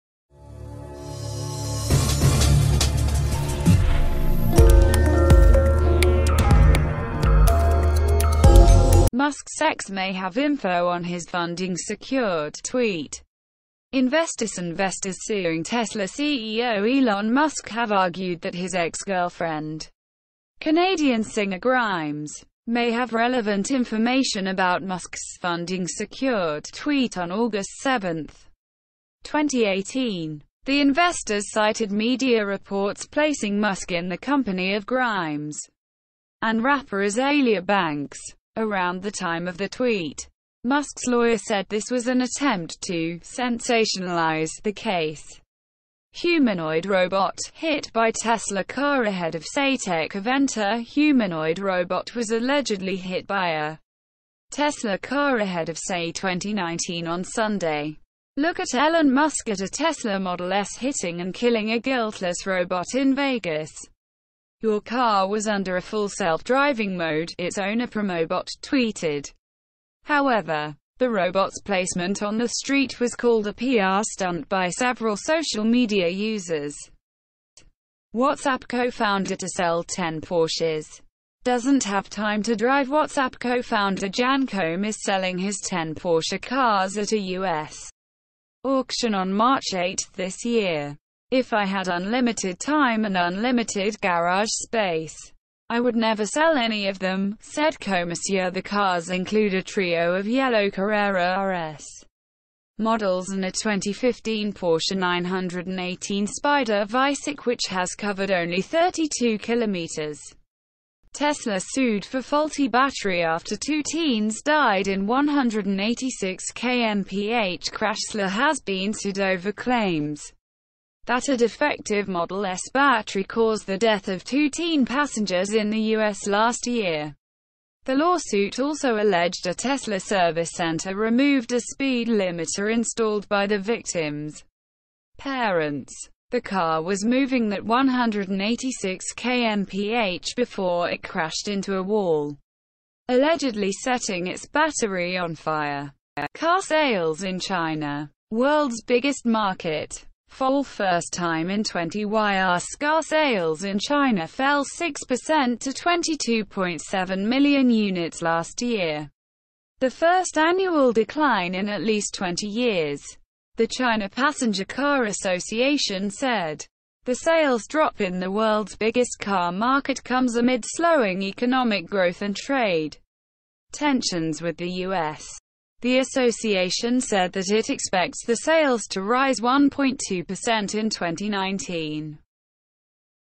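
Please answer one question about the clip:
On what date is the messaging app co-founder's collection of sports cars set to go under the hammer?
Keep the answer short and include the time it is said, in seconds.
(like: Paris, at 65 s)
March 8, at 89 s.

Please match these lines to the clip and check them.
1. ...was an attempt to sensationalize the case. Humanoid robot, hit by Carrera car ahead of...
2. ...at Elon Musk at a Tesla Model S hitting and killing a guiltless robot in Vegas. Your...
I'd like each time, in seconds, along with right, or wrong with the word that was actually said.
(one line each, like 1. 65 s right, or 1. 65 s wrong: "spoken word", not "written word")
1. 41 s wrong: "Tesla", not "Carrera"
2. 58 s right.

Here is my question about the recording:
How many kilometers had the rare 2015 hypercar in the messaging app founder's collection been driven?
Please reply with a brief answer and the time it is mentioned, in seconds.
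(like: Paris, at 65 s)
32, at 108 s.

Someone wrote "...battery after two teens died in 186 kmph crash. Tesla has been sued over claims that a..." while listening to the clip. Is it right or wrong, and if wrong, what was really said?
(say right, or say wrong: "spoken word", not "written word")
right.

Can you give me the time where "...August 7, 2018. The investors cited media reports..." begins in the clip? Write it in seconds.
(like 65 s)
27 s.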